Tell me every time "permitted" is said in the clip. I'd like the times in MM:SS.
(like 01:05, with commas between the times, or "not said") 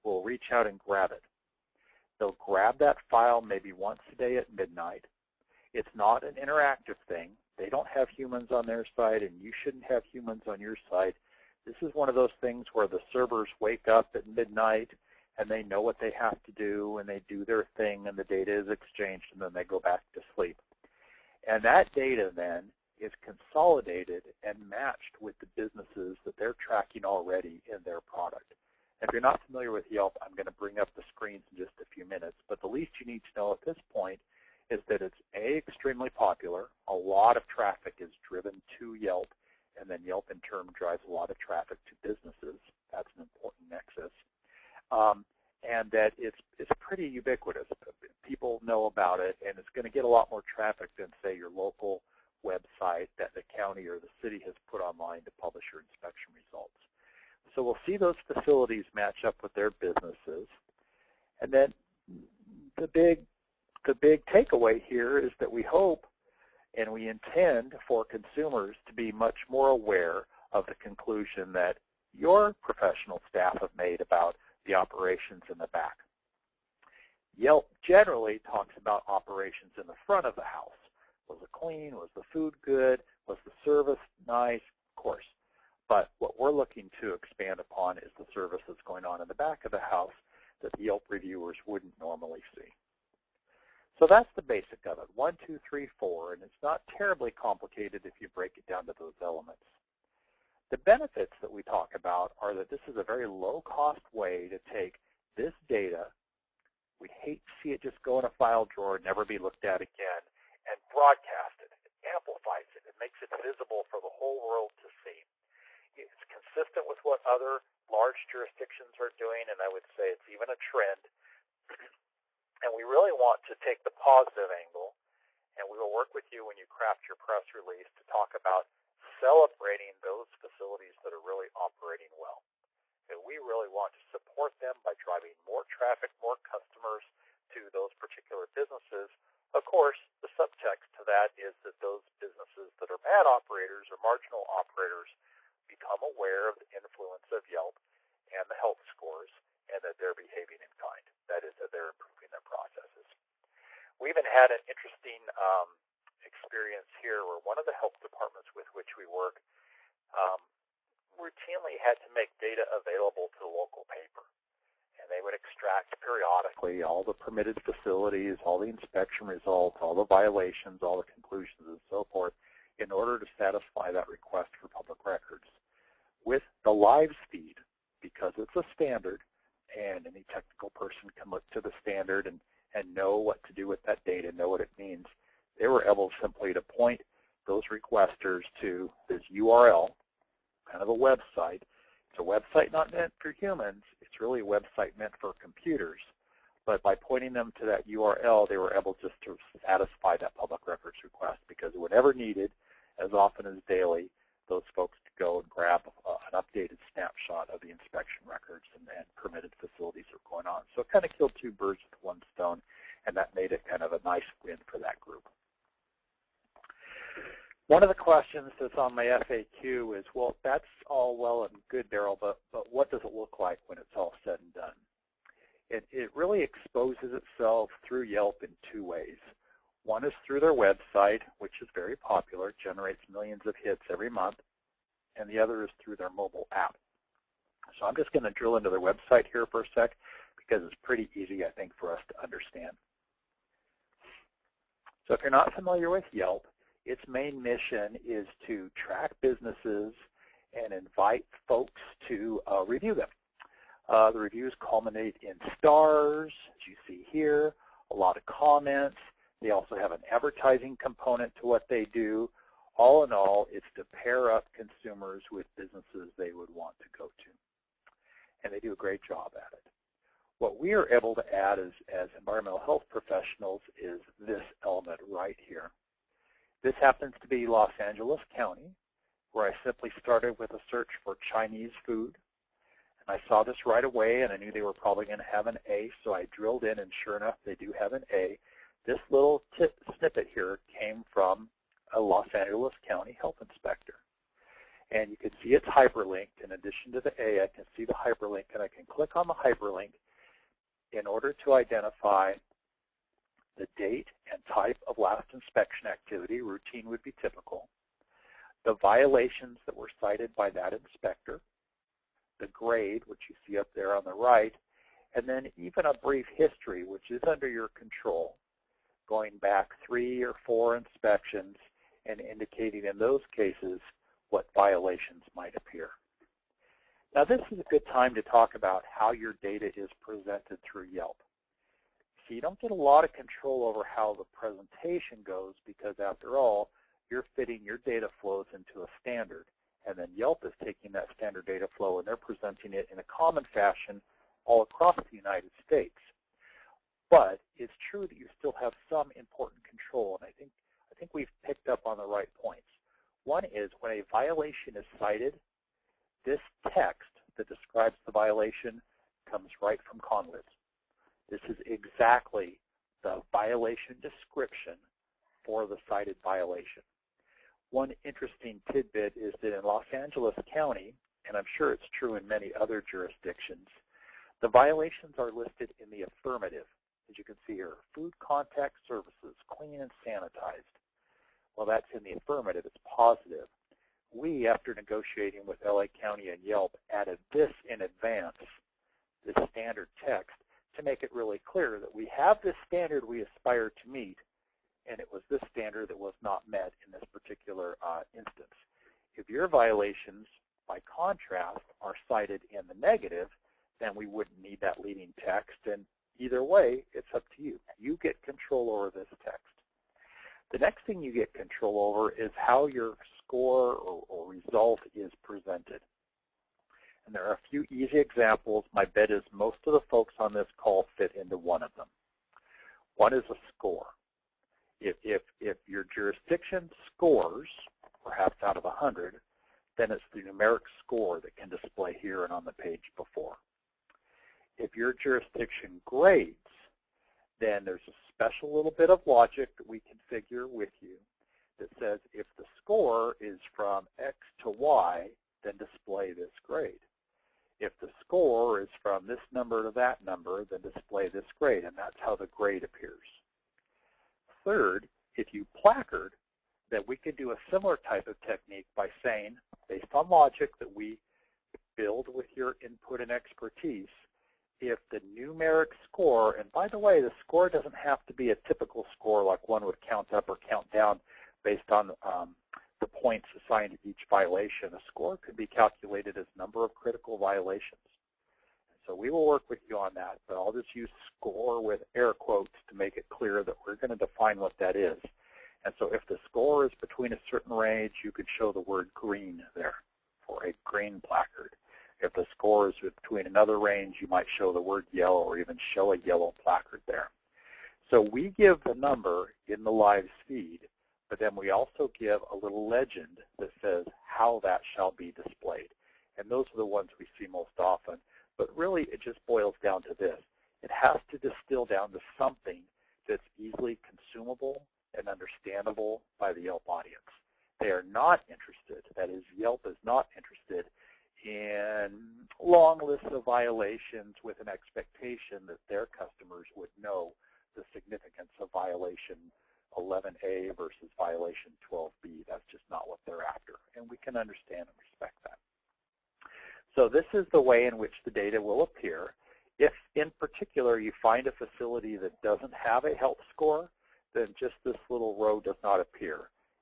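02:47, 03:29.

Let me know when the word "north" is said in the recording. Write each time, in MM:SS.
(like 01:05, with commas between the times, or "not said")
not said.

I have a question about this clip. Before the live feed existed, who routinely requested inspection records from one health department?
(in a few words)
The local paper.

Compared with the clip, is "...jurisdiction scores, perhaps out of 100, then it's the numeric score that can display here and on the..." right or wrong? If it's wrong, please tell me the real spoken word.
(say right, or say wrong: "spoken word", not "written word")
right.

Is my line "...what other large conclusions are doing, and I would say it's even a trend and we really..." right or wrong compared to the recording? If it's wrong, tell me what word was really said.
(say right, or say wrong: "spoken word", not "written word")
wrong: "jurisdictions", not "conclusions".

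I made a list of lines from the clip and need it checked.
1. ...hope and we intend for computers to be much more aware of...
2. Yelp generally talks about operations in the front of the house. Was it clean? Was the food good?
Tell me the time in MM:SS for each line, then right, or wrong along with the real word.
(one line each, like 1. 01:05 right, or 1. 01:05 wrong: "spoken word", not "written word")
1. 01:05 wrong: "consumers", not "computers"
2. 01:17 right.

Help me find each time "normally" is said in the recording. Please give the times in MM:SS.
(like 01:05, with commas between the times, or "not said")
01:31.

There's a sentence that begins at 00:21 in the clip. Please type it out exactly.
And that data then is consolidated and matched with the businesses that they're tracking already in their product.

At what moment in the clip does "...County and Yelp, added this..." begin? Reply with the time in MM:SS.
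06:25.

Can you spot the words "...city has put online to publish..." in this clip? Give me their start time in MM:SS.
00:54.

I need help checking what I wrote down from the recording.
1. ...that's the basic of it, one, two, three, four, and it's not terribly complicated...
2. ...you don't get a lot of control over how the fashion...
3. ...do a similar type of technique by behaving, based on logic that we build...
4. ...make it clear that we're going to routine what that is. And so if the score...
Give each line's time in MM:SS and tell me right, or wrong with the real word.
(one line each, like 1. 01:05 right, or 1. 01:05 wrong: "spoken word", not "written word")
1. 01:34 right
2. 05:32 wrong: "presentation", not "fashion"
3. 07:37 wrong: "saying", not "behaving"
4. 08:02 wrong: "define", not "routine".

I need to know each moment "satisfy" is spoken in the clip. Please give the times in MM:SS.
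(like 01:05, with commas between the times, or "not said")
02:53, 03:19.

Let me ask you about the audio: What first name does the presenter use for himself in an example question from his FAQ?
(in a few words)
Darryl.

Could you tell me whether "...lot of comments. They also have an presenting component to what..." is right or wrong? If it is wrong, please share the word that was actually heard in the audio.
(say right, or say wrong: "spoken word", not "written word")
wrong: "advertising", not "presenting".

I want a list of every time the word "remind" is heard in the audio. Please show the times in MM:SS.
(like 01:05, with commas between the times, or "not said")
not said.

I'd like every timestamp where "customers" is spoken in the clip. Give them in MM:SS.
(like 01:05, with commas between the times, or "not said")
02:16, 08:45.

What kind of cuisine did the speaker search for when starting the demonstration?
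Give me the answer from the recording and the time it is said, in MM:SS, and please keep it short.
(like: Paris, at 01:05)
Chinese food, at 04:41.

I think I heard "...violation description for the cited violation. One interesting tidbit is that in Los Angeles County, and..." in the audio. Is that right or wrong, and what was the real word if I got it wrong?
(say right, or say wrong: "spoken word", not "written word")
right.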